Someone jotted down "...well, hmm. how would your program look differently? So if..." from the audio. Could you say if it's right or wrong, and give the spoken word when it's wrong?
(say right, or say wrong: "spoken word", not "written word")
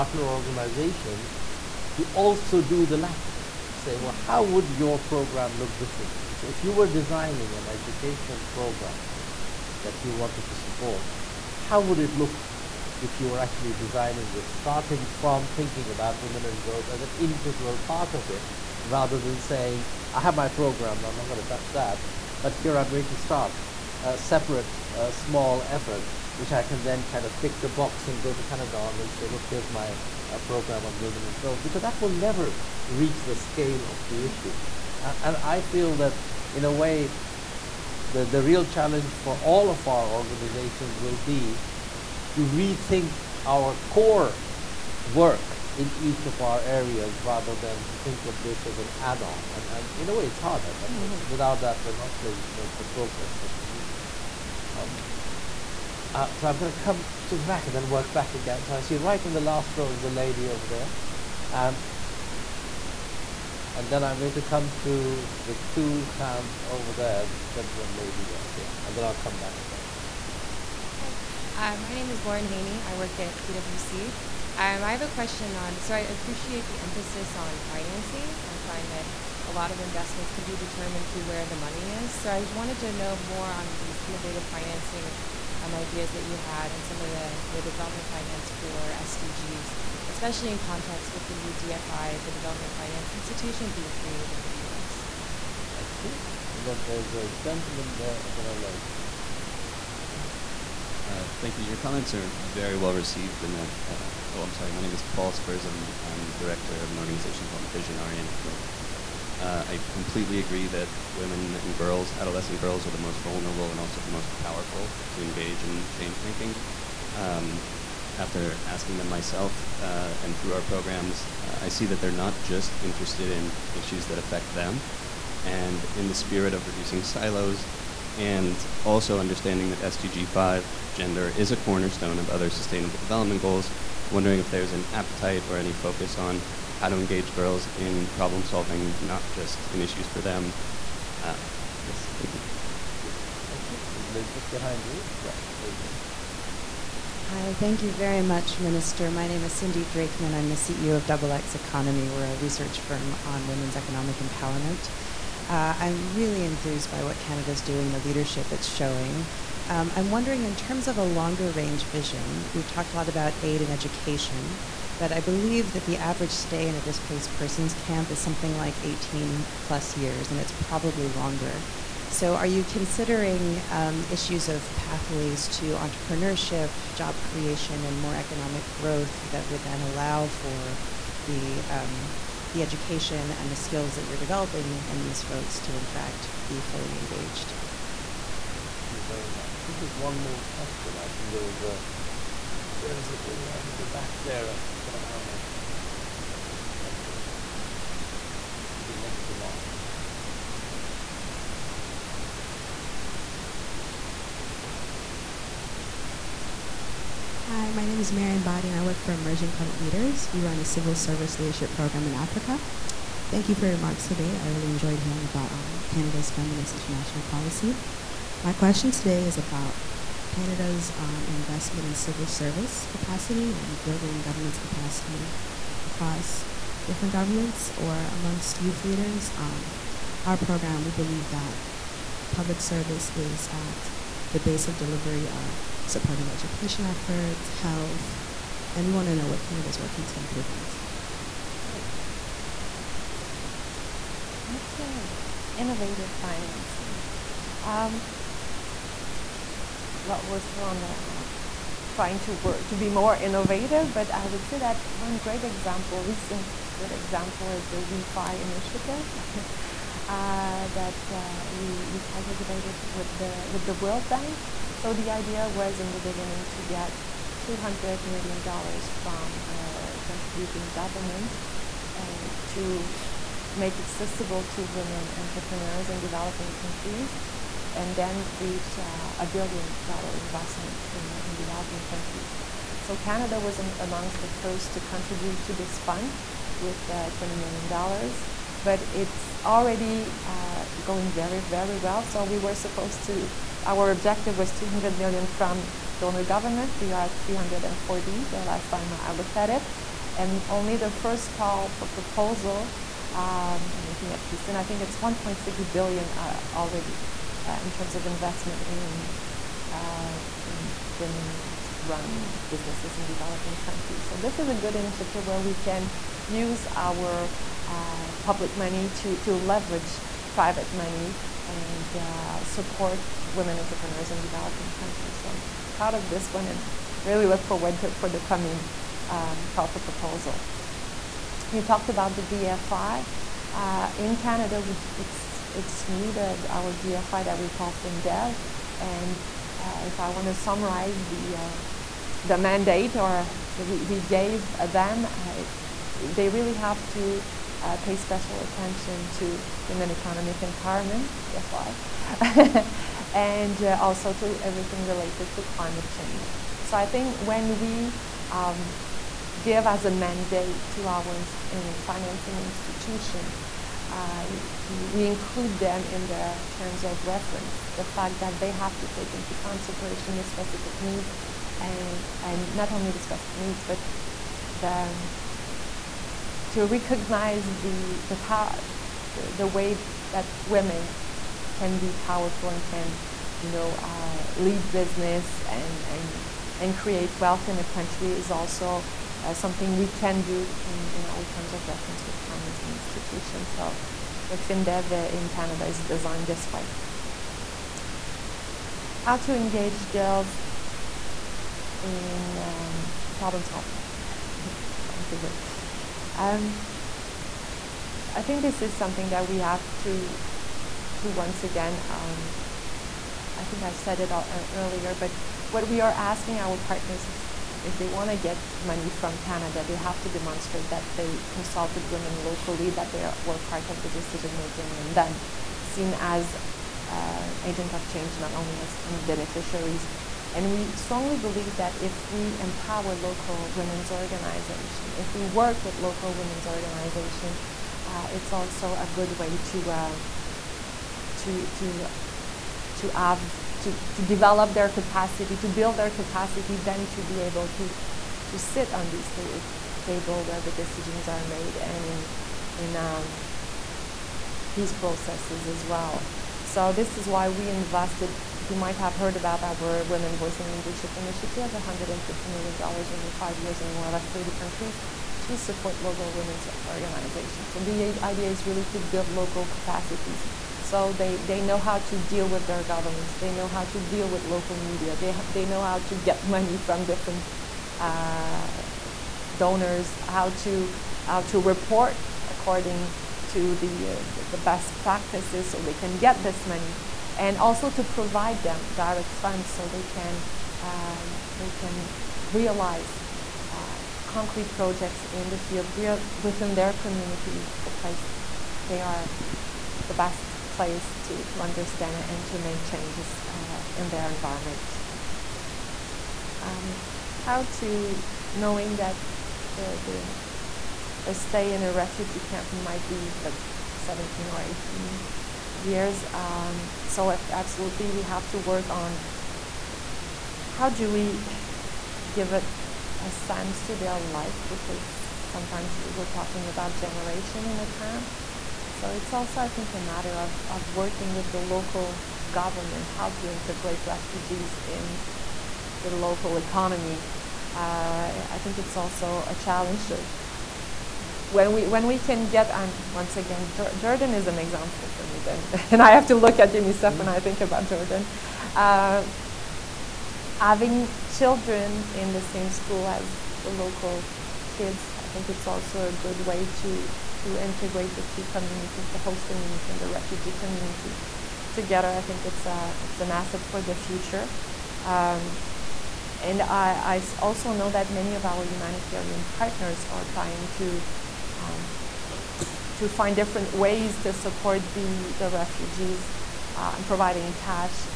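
right.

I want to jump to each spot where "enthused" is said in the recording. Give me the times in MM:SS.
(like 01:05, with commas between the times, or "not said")
02:36.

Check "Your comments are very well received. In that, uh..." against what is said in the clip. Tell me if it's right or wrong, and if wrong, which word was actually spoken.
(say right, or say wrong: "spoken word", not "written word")
right.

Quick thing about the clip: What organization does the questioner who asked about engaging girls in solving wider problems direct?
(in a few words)
Visionaria Network.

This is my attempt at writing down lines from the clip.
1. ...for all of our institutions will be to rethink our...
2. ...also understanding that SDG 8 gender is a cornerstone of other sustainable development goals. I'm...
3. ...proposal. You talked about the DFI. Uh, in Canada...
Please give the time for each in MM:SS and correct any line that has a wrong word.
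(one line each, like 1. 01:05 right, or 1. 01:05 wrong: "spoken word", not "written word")
1. 00:39 wrong: "organizations", not "institutions"
2. 02:08 wrong: "5", not "8"
3. 05:29 right.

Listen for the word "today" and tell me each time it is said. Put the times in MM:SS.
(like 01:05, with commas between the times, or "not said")
03:34, 03:38.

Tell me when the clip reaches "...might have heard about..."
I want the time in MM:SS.
07:38.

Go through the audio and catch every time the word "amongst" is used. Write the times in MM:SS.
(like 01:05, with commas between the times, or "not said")
03:48, 04:43.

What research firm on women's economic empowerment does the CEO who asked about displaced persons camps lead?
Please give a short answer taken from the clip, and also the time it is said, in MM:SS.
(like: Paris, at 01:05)
Double X Economy, at 02:31.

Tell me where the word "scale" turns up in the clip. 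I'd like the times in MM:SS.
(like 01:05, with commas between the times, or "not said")
00:33.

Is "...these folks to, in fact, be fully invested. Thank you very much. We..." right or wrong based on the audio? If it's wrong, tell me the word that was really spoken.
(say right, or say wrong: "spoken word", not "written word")
wrong: "engaged", not "invested".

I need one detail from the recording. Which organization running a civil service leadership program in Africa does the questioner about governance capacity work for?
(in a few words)
Emerging Public Leaders.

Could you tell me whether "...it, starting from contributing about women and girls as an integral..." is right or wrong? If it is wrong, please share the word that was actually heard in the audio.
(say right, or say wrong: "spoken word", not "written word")
wrong: "thinking", not "contributing".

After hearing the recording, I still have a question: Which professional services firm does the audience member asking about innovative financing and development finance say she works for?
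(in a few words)
PwC.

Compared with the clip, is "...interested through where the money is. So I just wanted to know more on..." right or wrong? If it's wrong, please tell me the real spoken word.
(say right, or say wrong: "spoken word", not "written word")
wrong: "determined", not "interested".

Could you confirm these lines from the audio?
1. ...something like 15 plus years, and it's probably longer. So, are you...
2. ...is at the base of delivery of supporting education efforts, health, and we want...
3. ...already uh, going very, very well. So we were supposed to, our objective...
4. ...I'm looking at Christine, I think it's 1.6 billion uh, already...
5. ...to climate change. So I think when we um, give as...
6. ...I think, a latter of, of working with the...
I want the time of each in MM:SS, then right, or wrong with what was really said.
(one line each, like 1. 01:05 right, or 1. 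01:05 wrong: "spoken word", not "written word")
1. 02:48 wrong: "18", not "15"
2. 03:53 right
3. 04:49 right
4. 05:03 right
5. 05:55 right
6. 08:49 wrong: "matter", not "latter".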